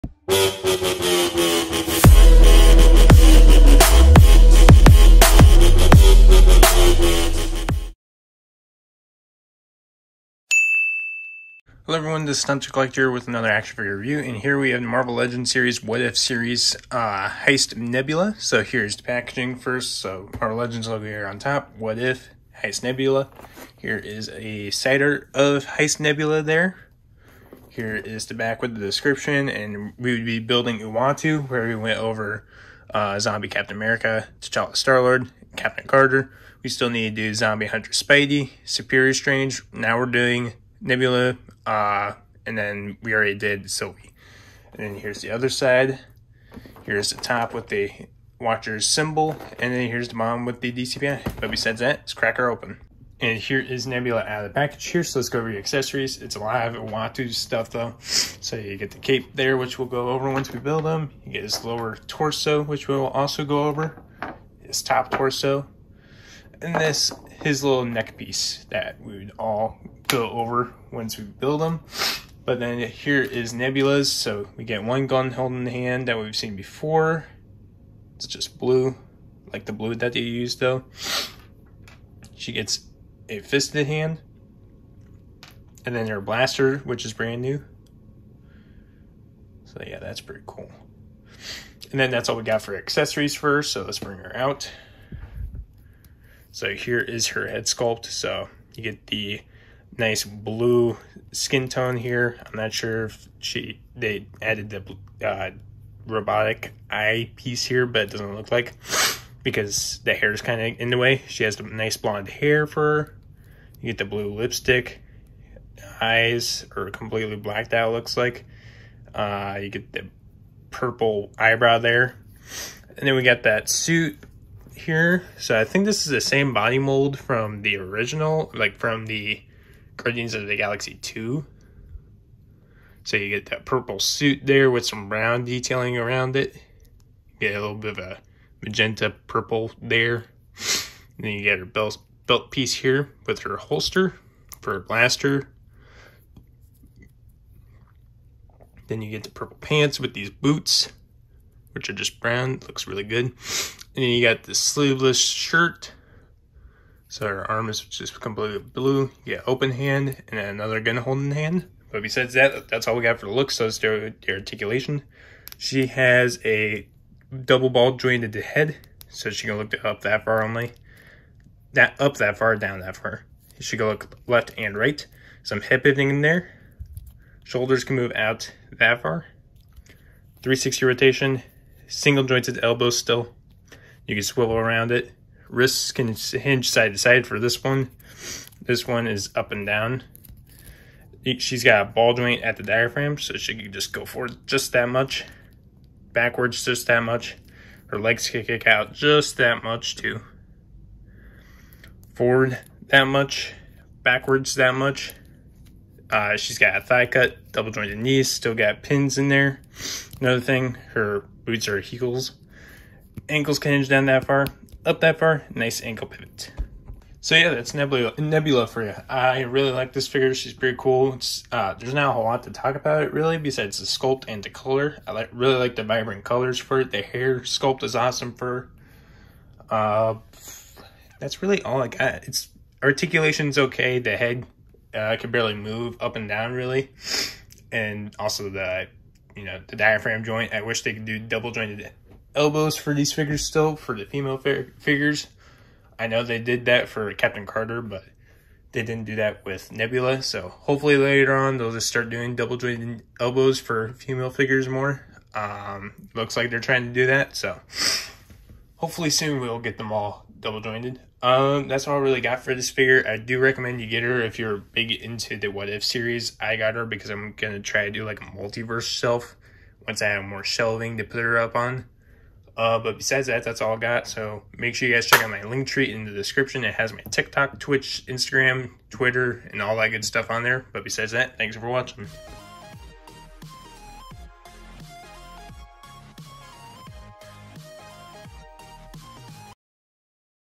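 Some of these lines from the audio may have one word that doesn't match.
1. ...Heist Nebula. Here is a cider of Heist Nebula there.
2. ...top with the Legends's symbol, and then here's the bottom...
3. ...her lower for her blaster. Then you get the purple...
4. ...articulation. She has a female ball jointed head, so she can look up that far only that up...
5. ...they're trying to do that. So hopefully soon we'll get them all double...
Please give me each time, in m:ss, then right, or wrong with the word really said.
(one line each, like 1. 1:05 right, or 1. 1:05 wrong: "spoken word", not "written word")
1. 0:22 right
2. 0:47 wrong: "Watcher", not "Legends"
3. 2:23 wrong: "holster", not "lower"
4. 2:44 wrong: "double", not "female"
5. 4:16 right.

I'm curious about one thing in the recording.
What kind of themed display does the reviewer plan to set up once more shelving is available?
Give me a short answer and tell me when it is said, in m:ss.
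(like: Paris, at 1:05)
Multiverse shelf, at 4:28.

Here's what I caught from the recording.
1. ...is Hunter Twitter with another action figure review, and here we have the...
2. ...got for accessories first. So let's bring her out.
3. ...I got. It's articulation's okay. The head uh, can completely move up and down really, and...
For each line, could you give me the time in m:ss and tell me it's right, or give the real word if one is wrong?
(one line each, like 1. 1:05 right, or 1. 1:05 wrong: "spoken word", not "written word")
1. 0:12 wrong: "Collector", not "Twitter"
2. 1:32 right
3. 3:51 wrong: "barely", not "completely".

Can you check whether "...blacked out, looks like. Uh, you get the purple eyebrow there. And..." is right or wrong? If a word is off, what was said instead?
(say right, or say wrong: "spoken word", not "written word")
right.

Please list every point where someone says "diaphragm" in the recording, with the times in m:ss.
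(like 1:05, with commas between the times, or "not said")
3:12, 3:59.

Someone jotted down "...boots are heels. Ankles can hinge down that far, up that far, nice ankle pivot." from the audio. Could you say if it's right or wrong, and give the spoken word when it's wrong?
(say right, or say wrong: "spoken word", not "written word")
right.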